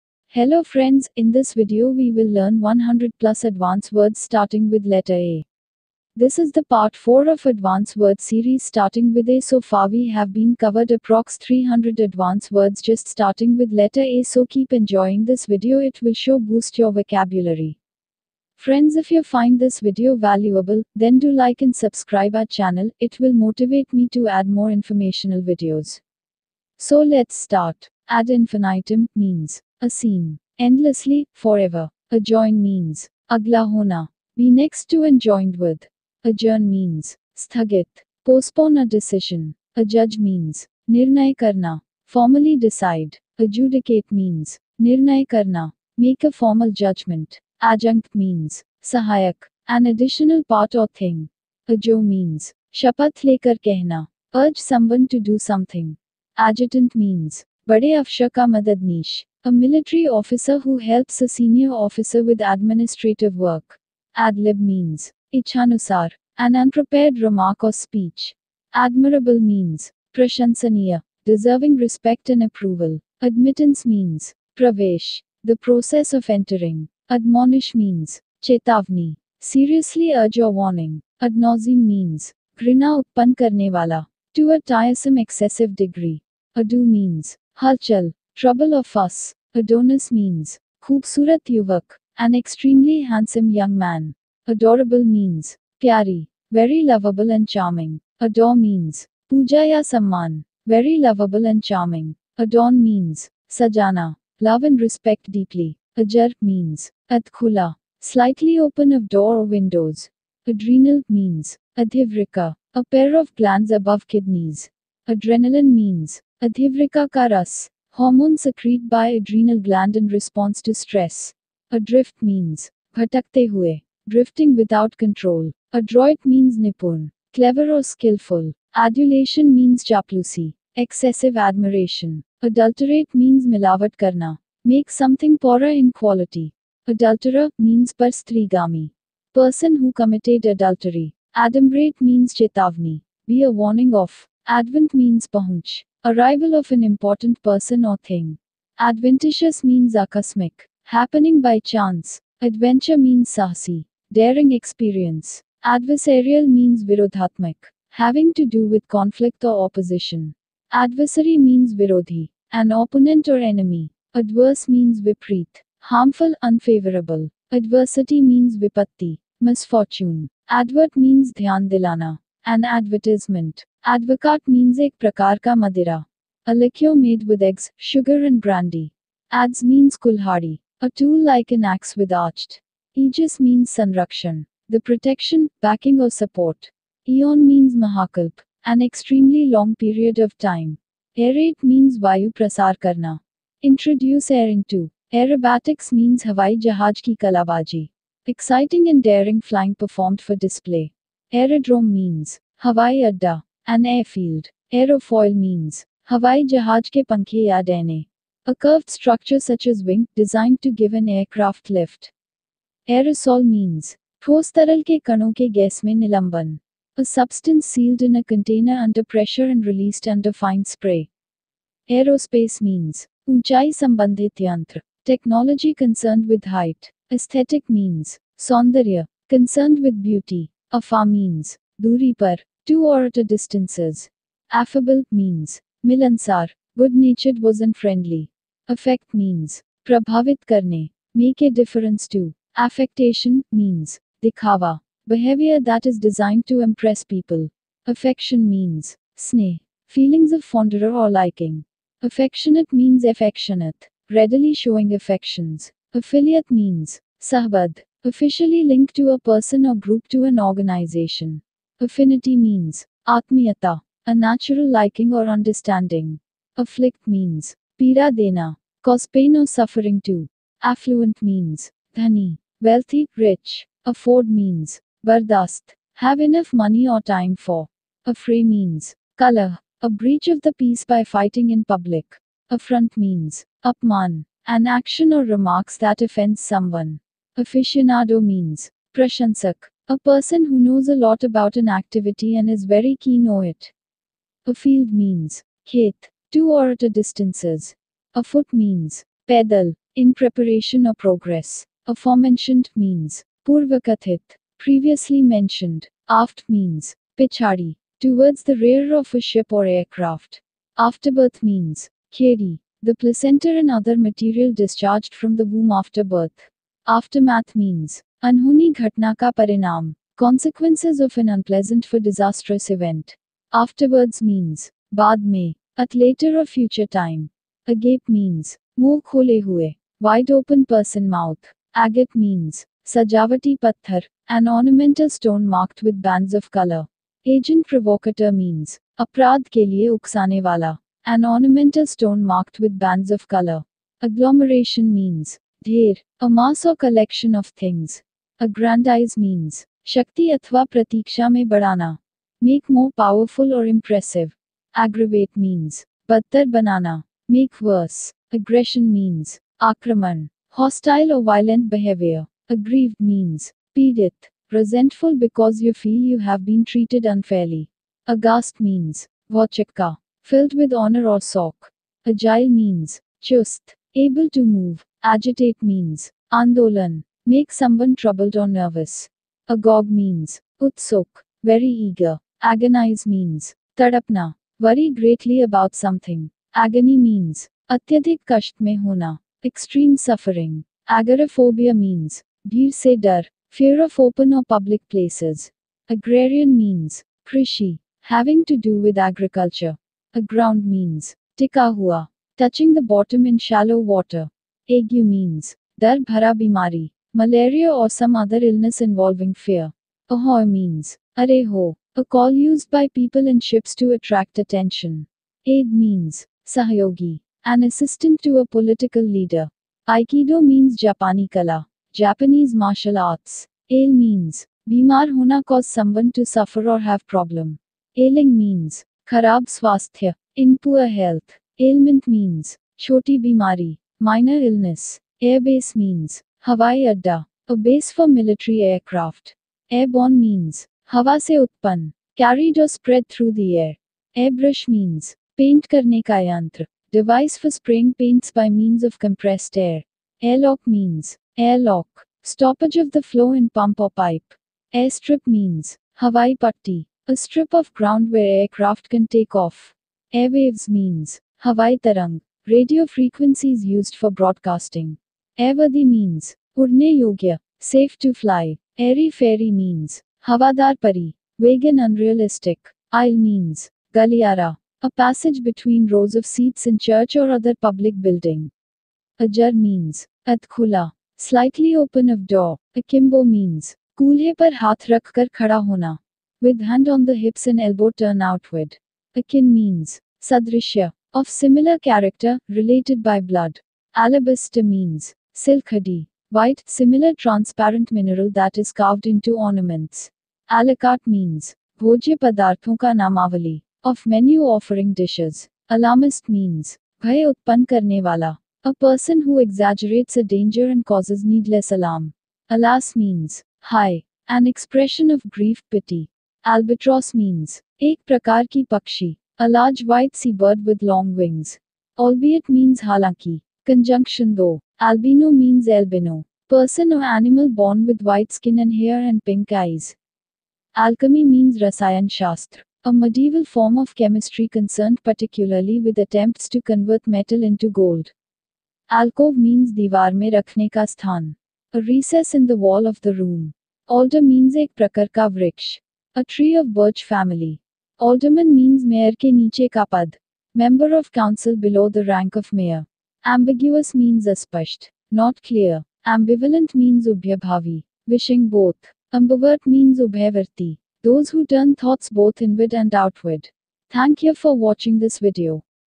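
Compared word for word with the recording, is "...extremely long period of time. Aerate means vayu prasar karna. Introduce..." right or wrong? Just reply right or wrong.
right.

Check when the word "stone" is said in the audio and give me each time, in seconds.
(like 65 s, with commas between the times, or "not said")
335 s, 341 s.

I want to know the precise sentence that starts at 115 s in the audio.
Adrenaline means Adhivrika karas, Hormones secreted by adrenal gland in response to stress.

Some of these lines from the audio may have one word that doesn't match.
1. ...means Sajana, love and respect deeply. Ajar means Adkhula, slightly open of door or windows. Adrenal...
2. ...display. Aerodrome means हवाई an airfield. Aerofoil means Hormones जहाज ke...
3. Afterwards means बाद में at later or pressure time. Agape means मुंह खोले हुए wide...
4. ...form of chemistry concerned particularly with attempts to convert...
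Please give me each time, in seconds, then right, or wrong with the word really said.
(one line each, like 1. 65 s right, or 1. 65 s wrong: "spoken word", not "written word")
1. 102 s right
2. 200 s wrong: "Hawaii", not "Hormones"
3. 323 s wrong: "future", not "pressure"
4. 533 s right.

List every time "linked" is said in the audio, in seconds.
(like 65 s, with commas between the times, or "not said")
258 s.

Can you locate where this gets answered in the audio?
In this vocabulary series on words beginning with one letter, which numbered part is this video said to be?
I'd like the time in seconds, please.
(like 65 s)
6 s.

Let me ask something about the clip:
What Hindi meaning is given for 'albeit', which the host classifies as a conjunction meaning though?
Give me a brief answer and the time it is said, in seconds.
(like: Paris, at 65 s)
halaki, at 522 s.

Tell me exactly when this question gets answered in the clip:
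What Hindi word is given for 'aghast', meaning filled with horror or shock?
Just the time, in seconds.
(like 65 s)
369 s.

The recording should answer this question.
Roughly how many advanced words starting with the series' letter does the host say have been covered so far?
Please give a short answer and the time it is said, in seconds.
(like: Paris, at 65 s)
300, at 11 s.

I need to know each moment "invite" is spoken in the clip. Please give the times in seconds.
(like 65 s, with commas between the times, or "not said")
not said.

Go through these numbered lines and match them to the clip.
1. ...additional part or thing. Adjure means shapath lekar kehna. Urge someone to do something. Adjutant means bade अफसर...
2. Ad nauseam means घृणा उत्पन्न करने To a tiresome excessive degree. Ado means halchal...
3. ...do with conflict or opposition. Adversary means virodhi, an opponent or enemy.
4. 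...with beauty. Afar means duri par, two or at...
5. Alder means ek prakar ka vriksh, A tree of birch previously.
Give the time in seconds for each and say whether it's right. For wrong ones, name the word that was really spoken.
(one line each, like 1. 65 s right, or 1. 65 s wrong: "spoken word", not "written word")
1. 49 s right
2. 81 s right
3. 158 s right
4. 229 s right
5. 543 s wrong: "family", not "previously".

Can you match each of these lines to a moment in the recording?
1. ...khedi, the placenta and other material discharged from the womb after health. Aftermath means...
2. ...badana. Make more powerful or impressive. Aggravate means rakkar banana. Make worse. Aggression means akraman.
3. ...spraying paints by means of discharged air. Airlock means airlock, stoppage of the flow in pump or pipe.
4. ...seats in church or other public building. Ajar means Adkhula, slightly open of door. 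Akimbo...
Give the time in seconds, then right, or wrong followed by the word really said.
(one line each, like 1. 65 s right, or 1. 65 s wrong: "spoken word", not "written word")
1. 312 s wrong: "birth", not "health"
2. 351 s wrong: "badtar", not "rakkar"
3. 447 s wrong: "compressed", not "discharged"
4. 476 s right.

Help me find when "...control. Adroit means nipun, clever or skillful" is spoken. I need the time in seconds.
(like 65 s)
124 s.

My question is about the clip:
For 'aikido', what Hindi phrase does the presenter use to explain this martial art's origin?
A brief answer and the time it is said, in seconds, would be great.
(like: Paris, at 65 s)
Japani kala, at 420 s.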